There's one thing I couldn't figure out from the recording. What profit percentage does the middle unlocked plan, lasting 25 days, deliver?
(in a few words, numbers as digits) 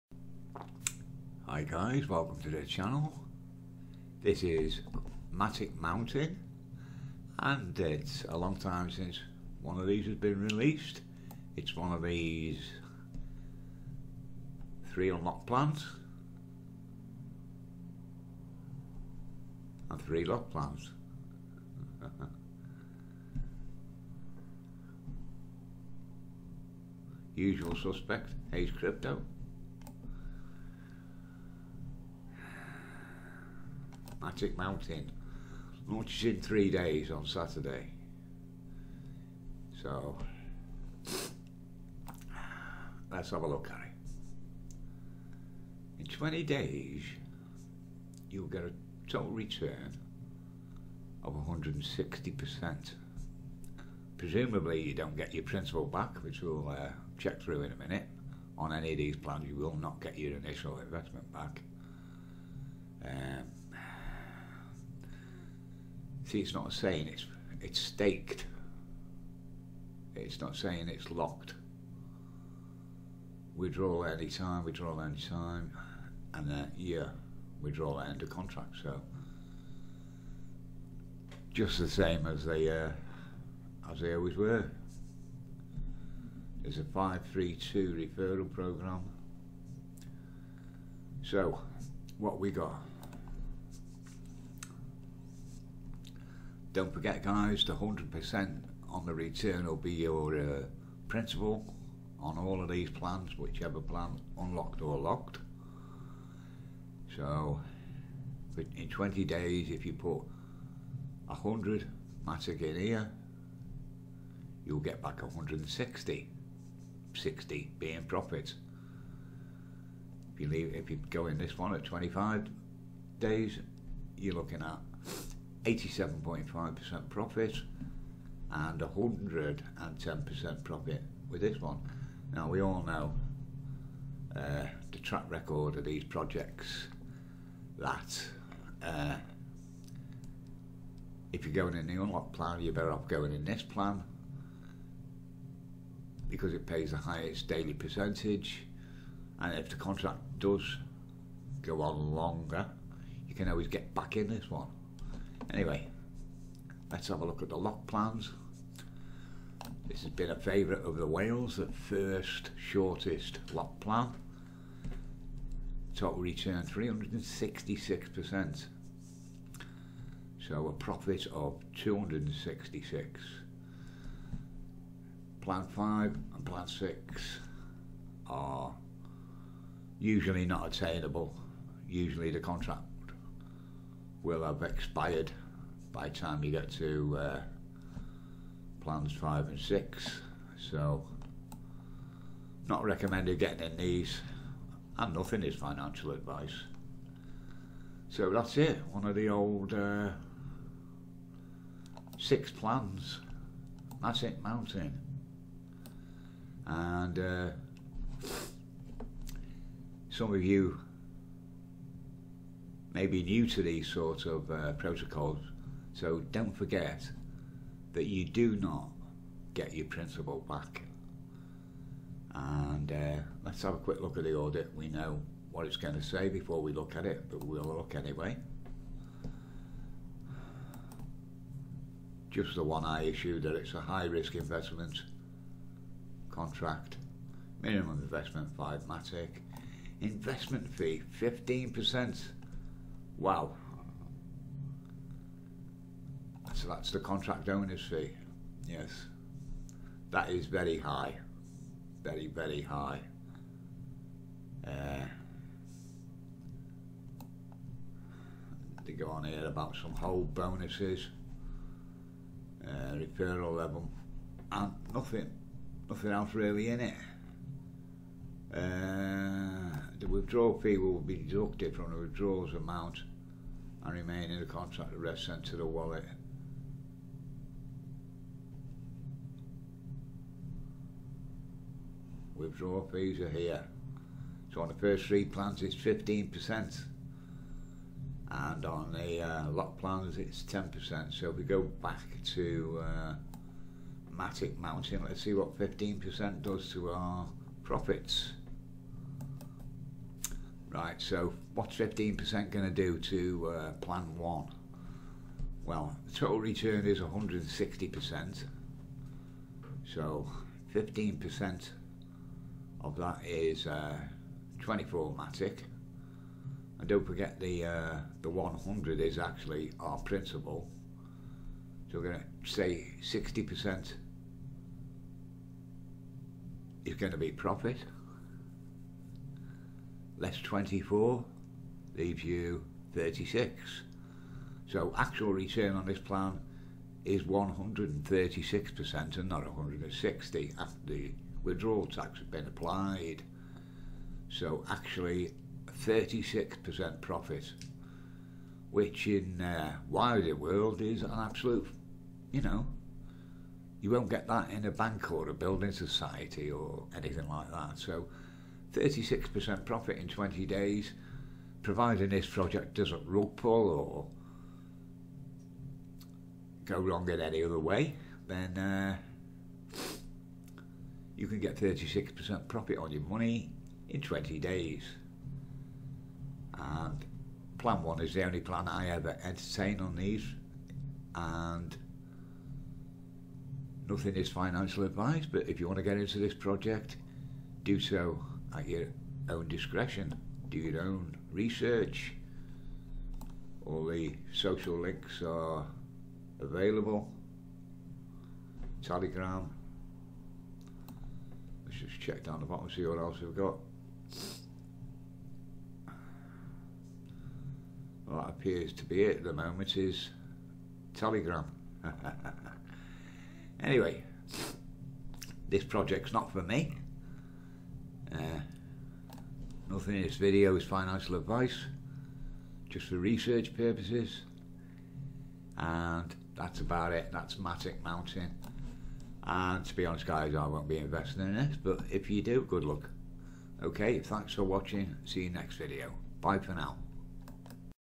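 87.5%.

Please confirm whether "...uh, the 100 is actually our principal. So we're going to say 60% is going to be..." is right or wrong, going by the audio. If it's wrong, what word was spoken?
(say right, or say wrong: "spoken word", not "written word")
right.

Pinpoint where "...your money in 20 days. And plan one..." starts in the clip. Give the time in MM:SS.
06:12.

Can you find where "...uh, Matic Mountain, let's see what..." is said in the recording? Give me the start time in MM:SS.
04:52.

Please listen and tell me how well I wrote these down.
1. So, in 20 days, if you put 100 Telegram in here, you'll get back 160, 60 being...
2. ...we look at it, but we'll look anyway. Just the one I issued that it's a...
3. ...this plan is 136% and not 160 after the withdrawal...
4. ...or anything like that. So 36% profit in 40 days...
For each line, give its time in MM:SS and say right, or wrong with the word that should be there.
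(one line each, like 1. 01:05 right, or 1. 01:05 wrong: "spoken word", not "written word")
1. 01:47 wrong: "Matic", not "Telegram"
2. 03:46 right
3. 05:35 right
4. 05:56 wrong: "20", not "40".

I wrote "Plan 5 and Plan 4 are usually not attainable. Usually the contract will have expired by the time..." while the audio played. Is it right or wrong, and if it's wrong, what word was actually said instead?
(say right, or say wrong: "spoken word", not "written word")
wrong: "6", not "4".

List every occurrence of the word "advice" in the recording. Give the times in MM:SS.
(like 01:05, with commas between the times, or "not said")
03:16, 06:24, 07:01.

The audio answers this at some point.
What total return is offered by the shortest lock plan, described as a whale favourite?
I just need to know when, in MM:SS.
02:46.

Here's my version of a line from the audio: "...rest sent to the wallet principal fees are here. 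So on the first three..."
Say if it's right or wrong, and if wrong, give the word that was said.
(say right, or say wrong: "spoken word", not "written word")
wrong: "withdrawal", not "principal".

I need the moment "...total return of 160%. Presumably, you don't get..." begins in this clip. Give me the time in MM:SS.
00:49.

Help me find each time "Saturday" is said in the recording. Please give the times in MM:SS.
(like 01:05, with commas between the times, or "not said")
00:37.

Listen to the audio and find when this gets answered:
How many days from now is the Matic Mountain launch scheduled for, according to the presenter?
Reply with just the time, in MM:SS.
00:36.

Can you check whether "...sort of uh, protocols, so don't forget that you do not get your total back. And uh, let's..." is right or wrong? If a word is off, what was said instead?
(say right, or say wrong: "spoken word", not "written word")
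wrong: "principal", not "total".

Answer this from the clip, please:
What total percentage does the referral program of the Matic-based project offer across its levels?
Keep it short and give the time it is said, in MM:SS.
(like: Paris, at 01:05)
532, at 01:26.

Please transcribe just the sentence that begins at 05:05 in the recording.
Well, the total return is 160%.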